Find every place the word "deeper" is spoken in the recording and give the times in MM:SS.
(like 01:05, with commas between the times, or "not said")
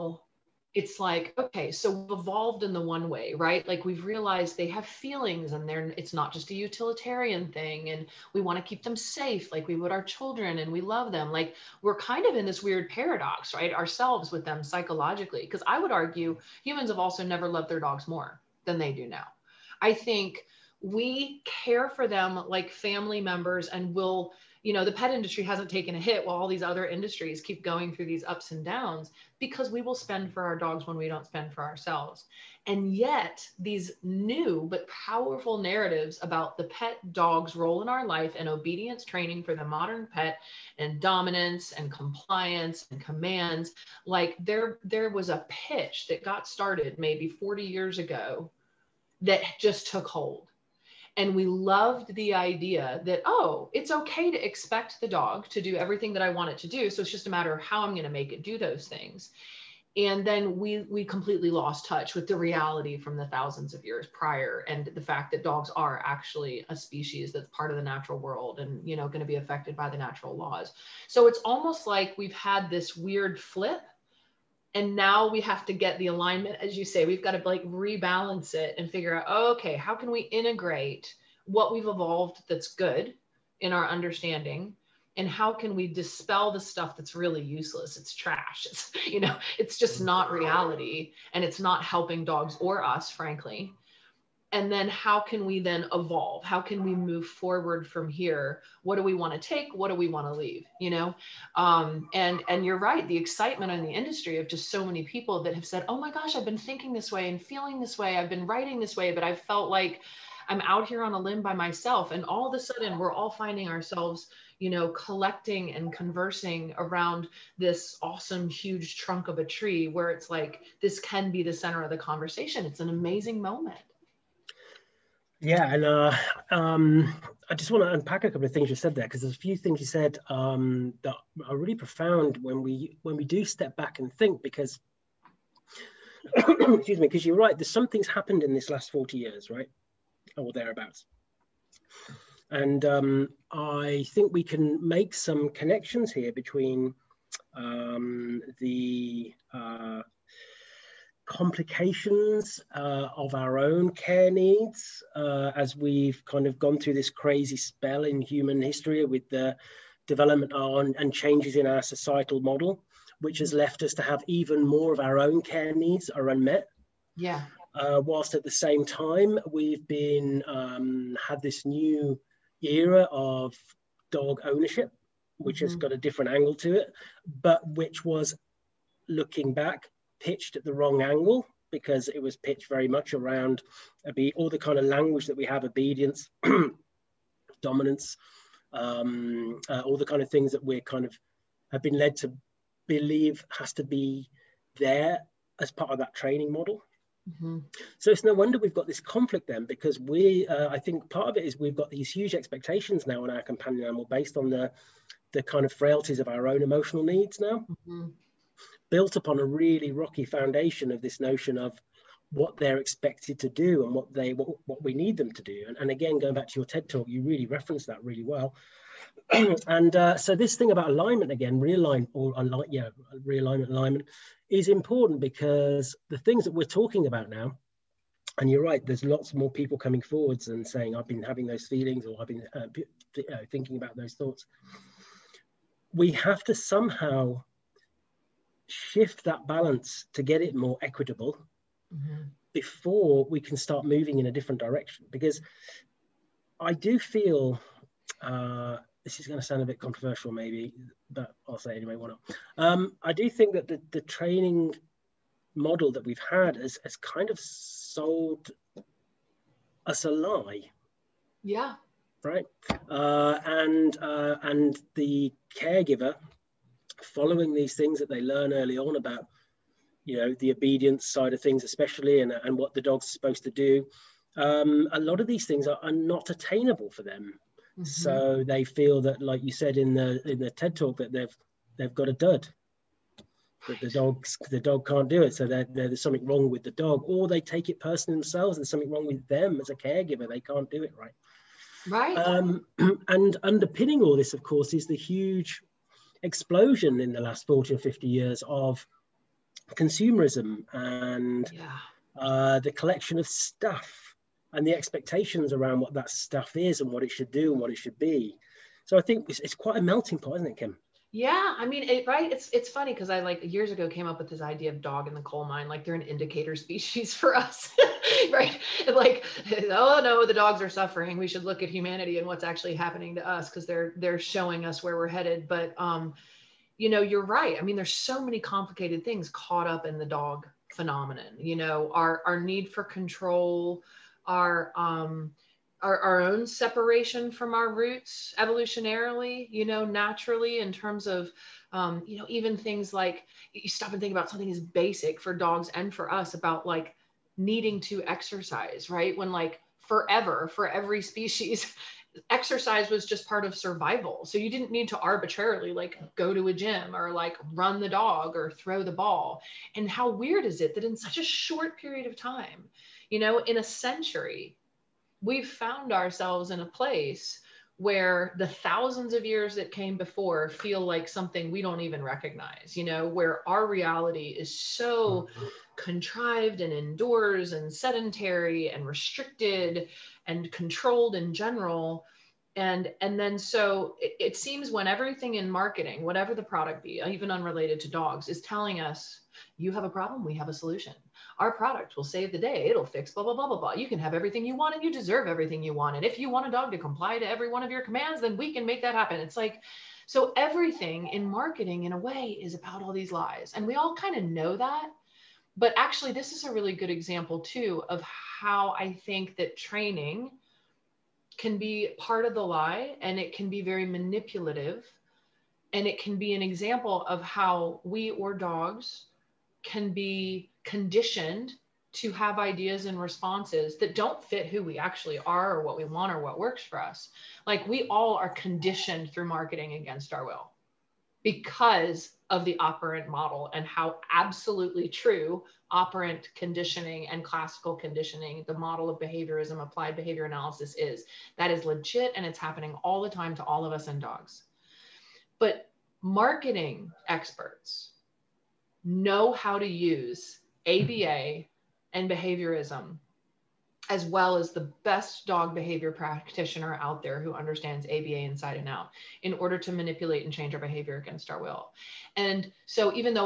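not said.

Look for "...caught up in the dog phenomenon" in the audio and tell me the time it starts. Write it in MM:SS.
05:29.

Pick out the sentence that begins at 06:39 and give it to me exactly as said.
It's like, so everything in marketing, in a way, is about all these lies.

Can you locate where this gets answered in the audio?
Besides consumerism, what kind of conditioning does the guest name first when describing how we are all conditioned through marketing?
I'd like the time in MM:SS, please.
07:15.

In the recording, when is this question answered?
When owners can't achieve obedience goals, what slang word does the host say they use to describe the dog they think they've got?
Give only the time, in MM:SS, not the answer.
04:42.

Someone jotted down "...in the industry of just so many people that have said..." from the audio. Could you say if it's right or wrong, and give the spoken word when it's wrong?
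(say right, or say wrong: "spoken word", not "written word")
right.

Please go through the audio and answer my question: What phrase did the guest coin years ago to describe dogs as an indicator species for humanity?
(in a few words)
Dog in the coal mine.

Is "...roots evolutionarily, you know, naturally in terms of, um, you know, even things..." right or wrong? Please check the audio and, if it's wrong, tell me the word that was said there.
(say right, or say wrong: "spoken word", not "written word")
right.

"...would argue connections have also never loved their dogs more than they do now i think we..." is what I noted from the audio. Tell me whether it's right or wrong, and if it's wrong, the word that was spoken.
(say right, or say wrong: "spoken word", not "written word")
wrong: "humans", not "connections".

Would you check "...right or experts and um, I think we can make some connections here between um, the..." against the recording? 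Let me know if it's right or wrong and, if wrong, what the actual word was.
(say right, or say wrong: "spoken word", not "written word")
wrong: "thereabouts", not "experts".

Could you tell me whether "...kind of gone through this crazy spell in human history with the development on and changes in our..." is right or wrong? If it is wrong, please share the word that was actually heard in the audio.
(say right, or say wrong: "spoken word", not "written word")
right.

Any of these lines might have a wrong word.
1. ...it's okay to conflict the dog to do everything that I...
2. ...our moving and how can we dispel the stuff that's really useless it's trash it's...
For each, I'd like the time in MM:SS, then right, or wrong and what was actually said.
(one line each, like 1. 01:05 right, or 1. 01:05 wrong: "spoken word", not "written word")
1. 00:53 wrong: "expect", not "conflict"
2. 01:23 wrong: "understanding", not "moving".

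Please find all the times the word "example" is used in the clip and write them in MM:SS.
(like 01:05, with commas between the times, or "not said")
06:46, 06:56.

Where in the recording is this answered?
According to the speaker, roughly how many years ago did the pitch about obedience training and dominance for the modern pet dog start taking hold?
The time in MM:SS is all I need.
00:47.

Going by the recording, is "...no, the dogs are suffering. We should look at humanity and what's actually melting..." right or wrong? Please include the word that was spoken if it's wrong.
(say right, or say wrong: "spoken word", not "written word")
wrong: "happening", not "melting".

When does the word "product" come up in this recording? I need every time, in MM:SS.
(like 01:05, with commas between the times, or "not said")
06:26, 06:31.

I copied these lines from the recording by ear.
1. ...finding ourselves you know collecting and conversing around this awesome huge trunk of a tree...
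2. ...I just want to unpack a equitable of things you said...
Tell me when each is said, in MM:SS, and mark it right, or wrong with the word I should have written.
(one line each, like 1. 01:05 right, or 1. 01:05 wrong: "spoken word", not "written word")
1. 01:53 right
2. 02:07 wrong: "couple", not "equitable".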